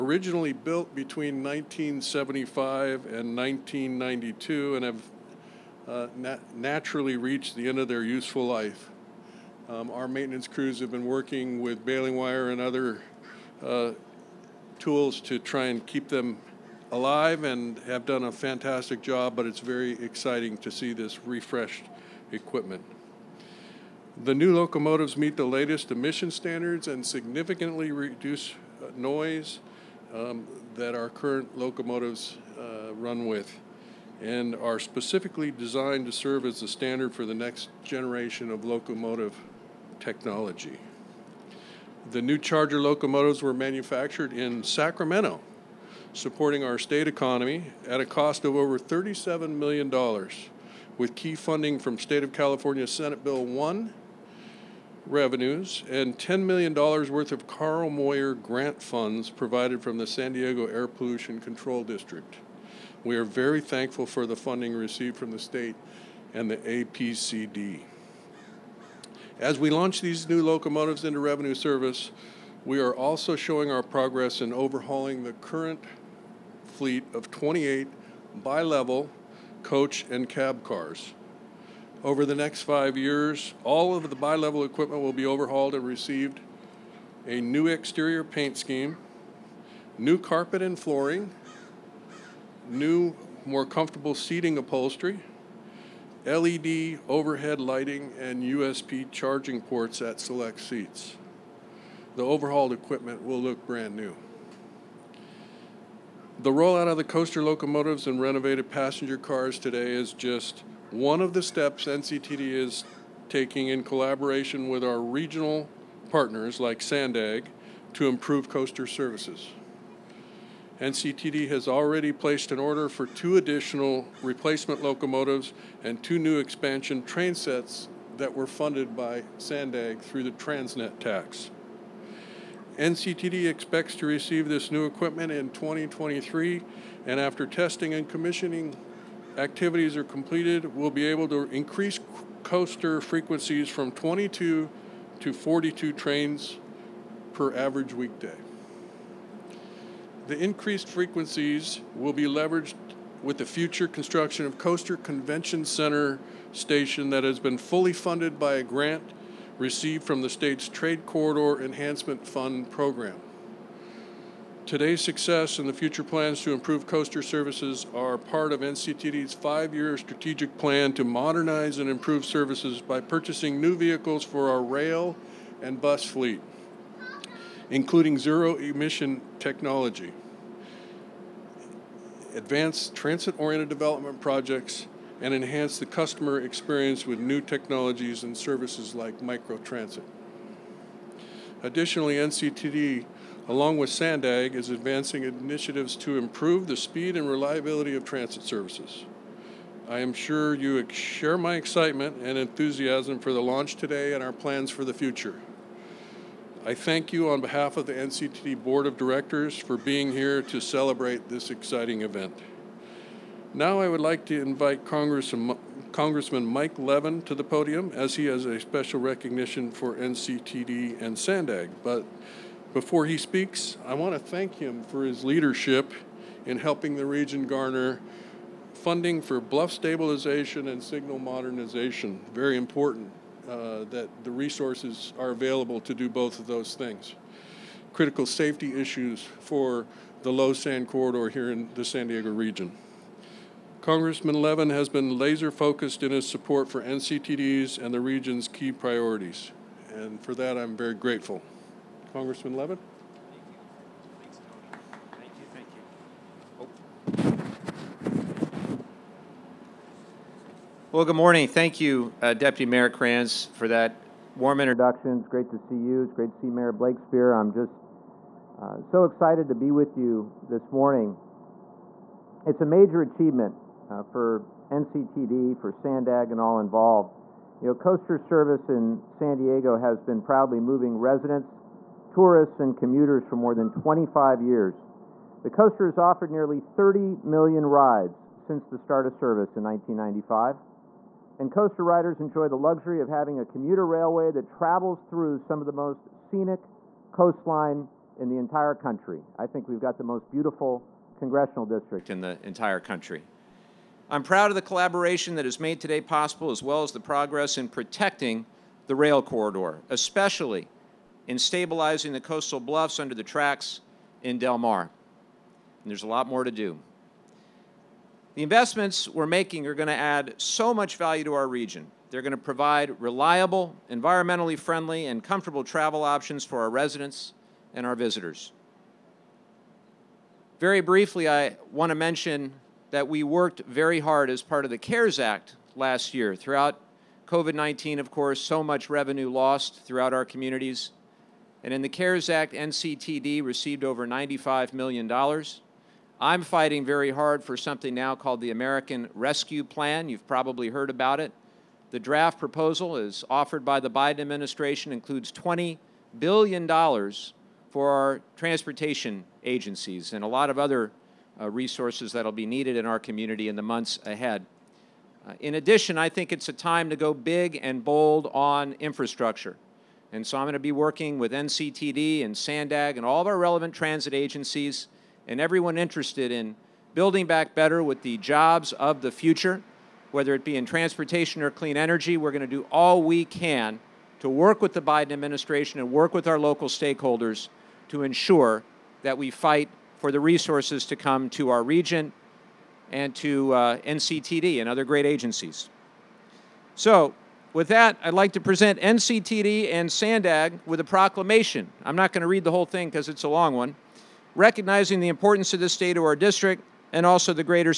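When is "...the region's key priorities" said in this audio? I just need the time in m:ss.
4:07.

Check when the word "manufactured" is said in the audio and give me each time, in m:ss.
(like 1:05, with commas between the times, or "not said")
0:43.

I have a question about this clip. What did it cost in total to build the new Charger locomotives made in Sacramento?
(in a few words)
over $37 million.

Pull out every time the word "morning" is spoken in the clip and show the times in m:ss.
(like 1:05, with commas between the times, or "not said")
4:21, 4:30.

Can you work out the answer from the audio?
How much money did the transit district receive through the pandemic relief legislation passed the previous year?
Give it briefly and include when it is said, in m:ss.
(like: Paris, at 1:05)
over $95 million, at 5:43.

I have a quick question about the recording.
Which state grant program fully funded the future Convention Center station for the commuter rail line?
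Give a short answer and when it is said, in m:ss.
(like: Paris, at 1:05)
Trade Corridor Enhancement Fund, at 2:40.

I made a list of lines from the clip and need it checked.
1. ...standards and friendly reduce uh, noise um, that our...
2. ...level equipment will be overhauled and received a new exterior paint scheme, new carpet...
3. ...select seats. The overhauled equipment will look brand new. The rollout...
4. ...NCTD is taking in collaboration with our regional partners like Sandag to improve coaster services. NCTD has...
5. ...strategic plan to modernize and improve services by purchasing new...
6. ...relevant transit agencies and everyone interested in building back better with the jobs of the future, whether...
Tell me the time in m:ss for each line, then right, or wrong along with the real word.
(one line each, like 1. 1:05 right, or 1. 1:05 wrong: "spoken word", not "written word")
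1. 0:26 wrong: "significantly", not "friendly"
2. 1:24 right
3. 1:40 right
4. 1:51 right
5. 2:49 right
6. 6:13 right.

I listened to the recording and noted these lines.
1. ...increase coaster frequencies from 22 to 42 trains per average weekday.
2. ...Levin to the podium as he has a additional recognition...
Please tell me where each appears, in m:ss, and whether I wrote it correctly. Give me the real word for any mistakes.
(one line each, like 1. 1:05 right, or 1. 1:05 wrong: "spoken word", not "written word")
1. 2:21 right
2. 3:36 wrong: "special", not "additional".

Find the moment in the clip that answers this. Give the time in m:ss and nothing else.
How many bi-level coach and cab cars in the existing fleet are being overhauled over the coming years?
1:17.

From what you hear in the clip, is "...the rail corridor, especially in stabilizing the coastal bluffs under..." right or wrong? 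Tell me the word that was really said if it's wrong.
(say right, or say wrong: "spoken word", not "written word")
right.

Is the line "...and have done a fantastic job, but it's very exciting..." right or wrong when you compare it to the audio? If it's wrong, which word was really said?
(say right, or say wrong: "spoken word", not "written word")
right.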